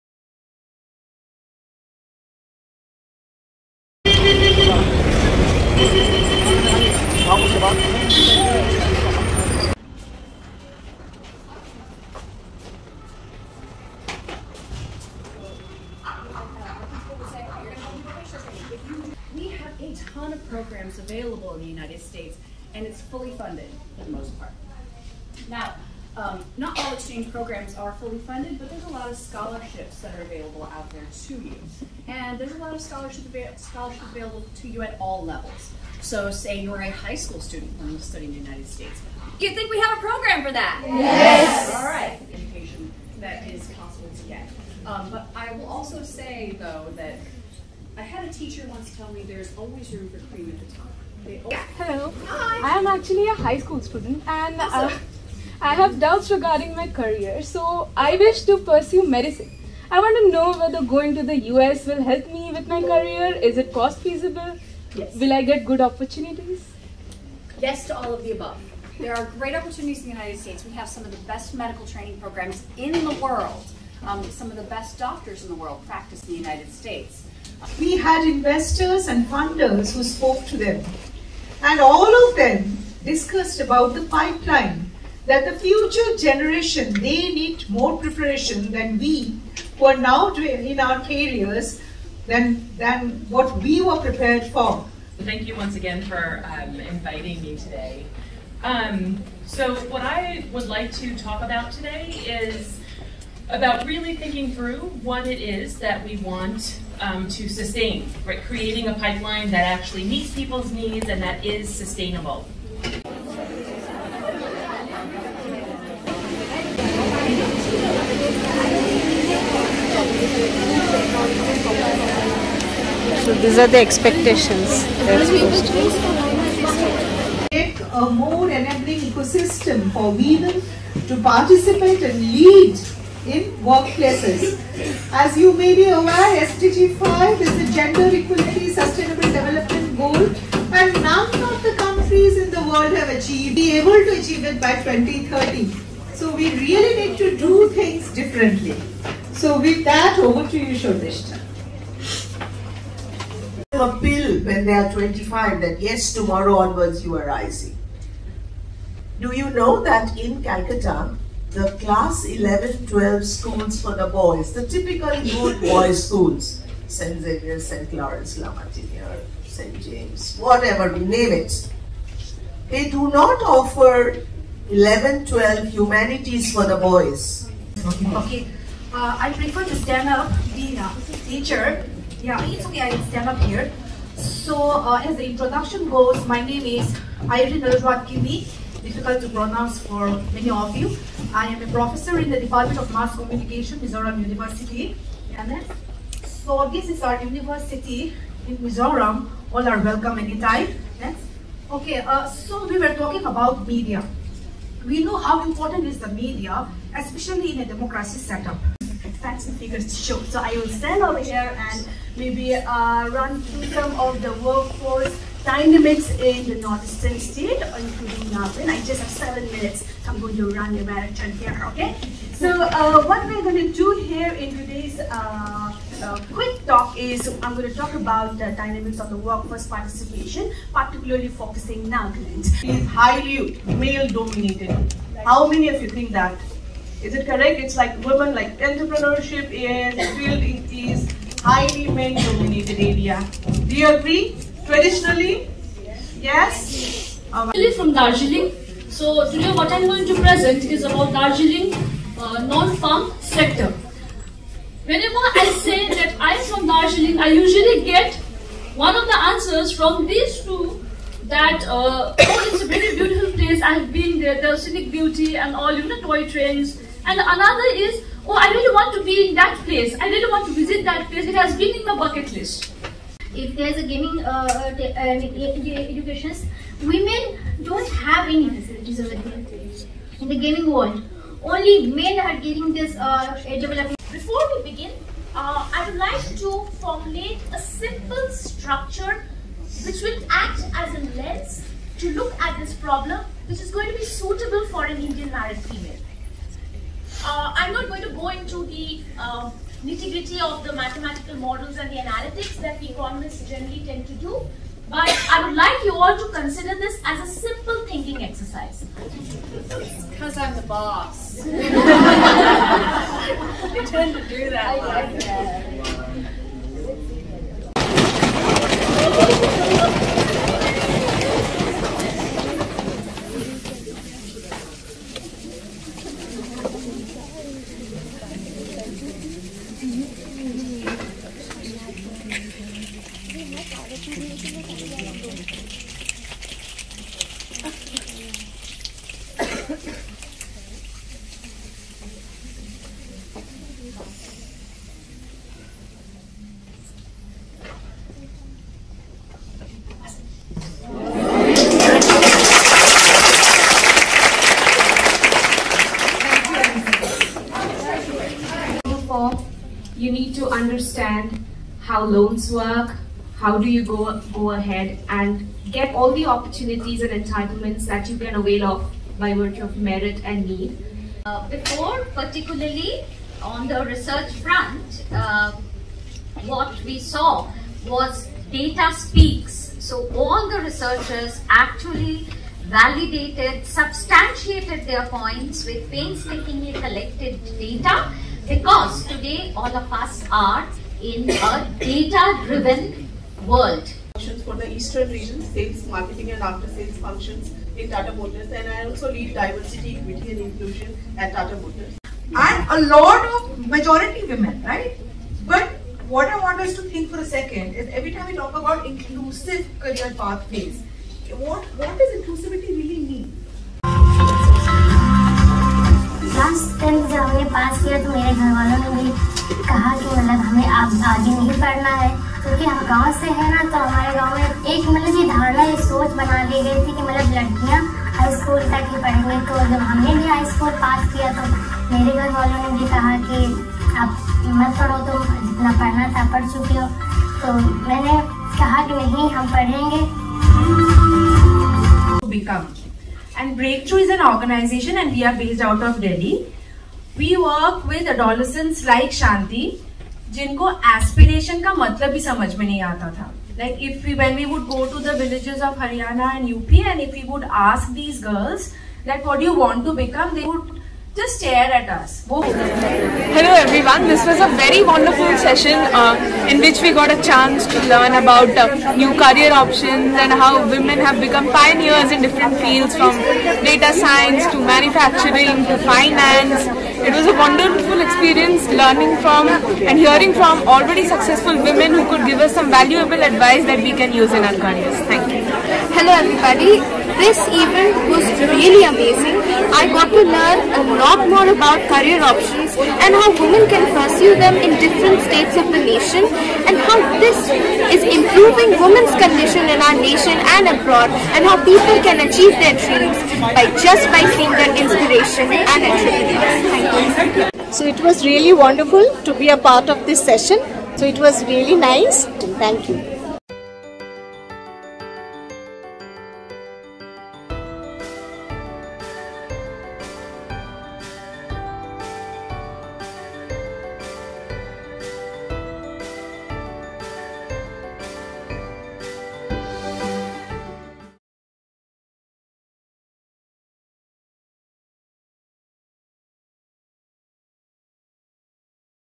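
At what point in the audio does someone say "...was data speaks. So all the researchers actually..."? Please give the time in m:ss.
6:17.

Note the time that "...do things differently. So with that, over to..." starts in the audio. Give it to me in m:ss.
2:27.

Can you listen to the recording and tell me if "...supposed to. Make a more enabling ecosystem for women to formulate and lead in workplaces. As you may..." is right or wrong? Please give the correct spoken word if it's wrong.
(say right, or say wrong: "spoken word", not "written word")
wrong: "participate", not "formulate".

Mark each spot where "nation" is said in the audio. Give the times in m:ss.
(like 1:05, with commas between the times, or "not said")
8:15, 8:19.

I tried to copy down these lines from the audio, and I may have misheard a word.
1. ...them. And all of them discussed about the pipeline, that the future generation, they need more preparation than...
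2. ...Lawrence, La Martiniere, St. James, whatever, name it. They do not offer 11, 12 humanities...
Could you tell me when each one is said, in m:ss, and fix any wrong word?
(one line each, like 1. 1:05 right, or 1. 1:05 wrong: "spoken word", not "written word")
1. 1:20 right
2. 2:47 right.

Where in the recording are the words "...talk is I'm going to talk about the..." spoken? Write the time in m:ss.
3:46.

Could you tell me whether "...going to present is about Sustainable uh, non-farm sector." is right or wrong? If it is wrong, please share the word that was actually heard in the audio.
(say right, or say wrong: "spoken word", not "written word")
wrong: "Darjeeling", not "Sustainable".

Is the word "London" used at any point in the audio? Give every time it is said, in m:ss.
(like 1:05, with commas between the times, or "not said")
not said.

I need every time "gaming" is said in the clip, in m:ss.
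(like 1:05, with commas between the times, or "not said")
4:33, 4:40.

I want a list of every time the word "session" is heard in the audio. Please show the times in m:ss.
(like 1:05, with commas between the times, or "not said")
7:45, 8:30.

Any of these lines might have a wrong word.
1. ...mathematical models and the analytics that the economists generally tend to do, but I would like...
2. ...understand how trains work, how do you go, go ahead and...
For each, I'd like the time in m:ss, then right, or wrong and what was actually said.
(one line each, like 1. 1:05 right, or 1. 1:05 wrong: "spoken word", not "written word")
1. 5:00 right
2. 6:00 wrong: "loans", not "trains".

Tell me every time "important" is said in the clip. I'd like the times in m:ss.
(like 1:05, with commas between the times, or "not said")
3:25.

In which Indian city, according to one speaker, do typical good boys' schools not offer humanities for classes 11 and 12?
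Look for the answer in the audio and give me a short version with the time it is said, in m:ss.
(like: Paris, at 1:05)
Calcutta, at 2:40.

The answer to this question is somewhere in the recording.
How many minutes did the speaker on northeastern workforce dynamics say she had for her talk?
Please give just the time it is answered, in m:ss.
3:39.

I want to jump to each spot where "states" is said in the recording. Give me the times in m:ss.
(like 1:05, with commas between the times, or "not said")
0:21, 0:38, 1:10, 1:16, 3:37, 8:15.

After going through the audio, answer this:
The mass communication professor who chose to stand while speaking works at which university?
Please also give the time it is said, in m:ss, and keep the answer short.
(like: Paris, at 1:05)
Mizoram University, at 3:13.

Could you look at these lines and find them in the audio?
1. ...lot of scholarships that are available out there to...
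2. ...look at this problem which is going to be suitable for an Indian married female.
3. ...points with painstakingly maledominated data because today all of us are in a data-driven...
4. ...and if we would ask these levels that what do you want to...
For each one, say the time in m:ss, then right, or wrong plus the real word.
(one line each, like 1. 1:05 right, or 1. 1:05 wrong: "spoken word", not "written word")
1. 0:28 right
2. 4:52 right
3. 6:25 wrong: "collected", not "maledominated"
4. 7:36 wrong: "girls", not "levels".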